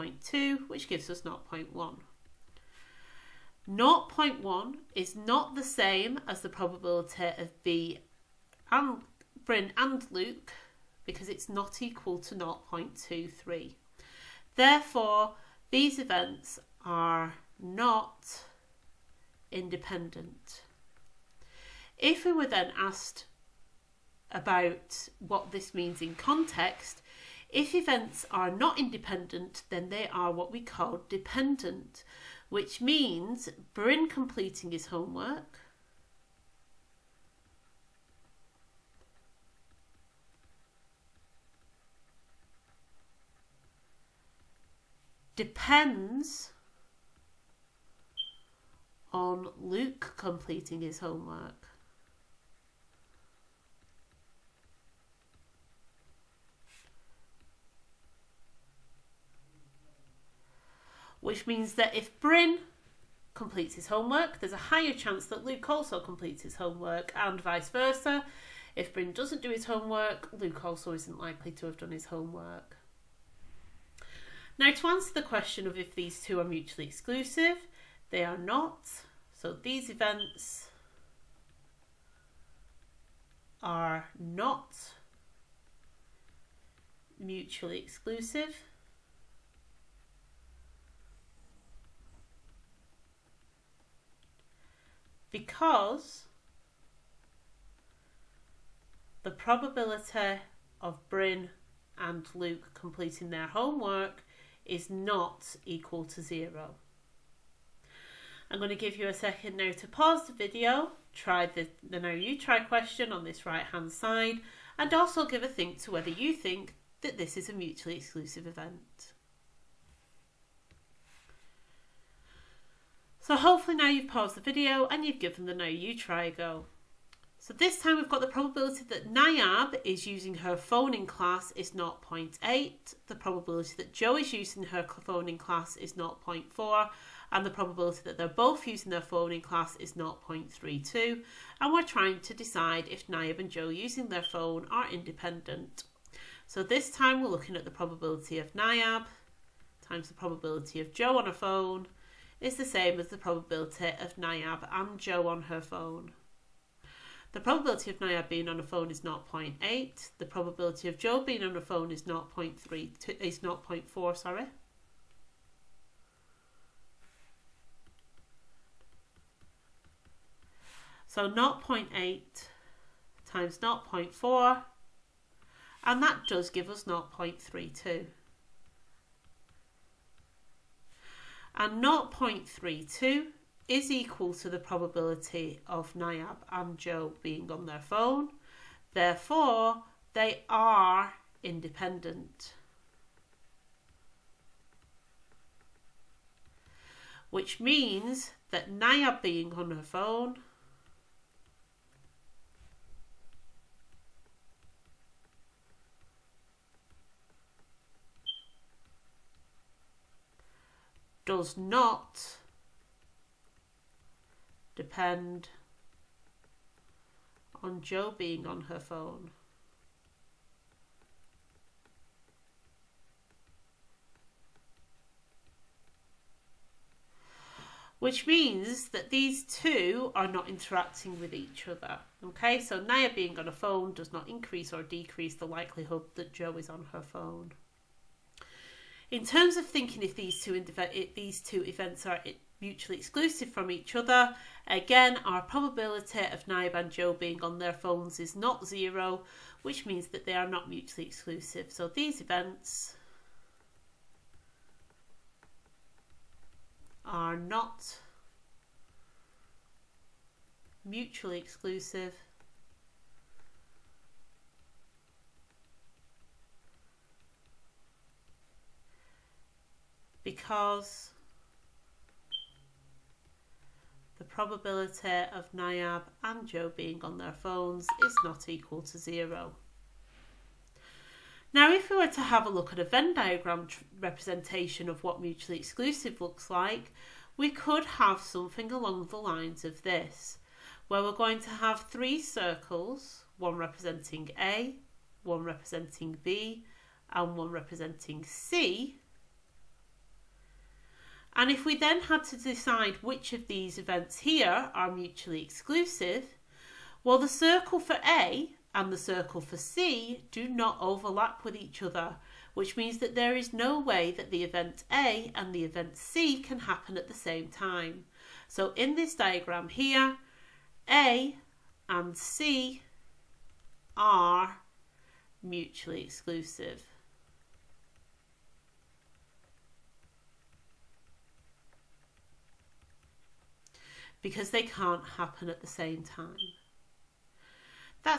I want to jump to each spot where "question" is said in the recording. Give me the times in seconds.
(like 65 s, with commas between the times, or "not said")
75 s, 112 s.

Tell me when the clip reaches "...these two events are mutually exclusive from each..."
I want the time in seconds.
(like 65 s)
241 s.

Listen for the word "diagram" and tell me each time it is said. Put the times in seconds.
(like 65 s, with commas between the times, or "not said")
283 s, 319 s.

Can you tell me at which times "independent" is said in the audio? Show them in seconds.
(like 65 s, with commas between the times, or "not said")
19 s, 28 s, 144 s, 191 s.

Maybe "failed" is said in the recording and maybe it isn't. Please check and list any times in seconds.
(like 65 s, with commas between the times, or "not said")
not said.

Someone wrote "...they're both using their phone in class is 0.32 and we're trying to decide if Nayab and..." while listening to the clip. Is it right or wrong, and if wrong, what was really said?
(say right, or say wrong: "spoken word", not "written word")
right.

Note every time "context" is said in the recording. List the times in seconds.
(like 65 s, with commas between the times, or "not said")
26 s.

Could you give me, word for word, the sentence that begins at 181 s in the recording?
And 0.32 is equal to the probability of Nayab and Joe being on their phone.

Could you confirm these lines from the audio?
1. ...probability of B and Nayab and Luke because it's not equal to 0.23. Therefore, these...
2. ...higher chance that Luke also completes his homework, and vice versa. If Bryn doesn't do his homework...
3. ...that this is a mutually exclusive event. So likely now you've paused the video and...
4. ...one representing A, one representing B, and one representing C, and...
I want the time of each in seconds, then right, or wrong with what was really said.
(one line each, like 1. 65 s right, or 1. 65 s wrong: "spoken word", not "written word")
1. 6 s wrong: "Bryn", not "Nayab"
2. 64 s right
3. 116 s wrong: "hopefully", not "likely"
4. 293 s right.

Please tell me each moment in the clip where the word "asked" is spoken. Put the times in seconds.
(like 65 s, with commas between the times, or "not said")
22 s.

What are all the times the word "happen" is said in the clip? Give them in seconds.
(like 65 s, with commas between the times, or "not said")
316 s, 335 s.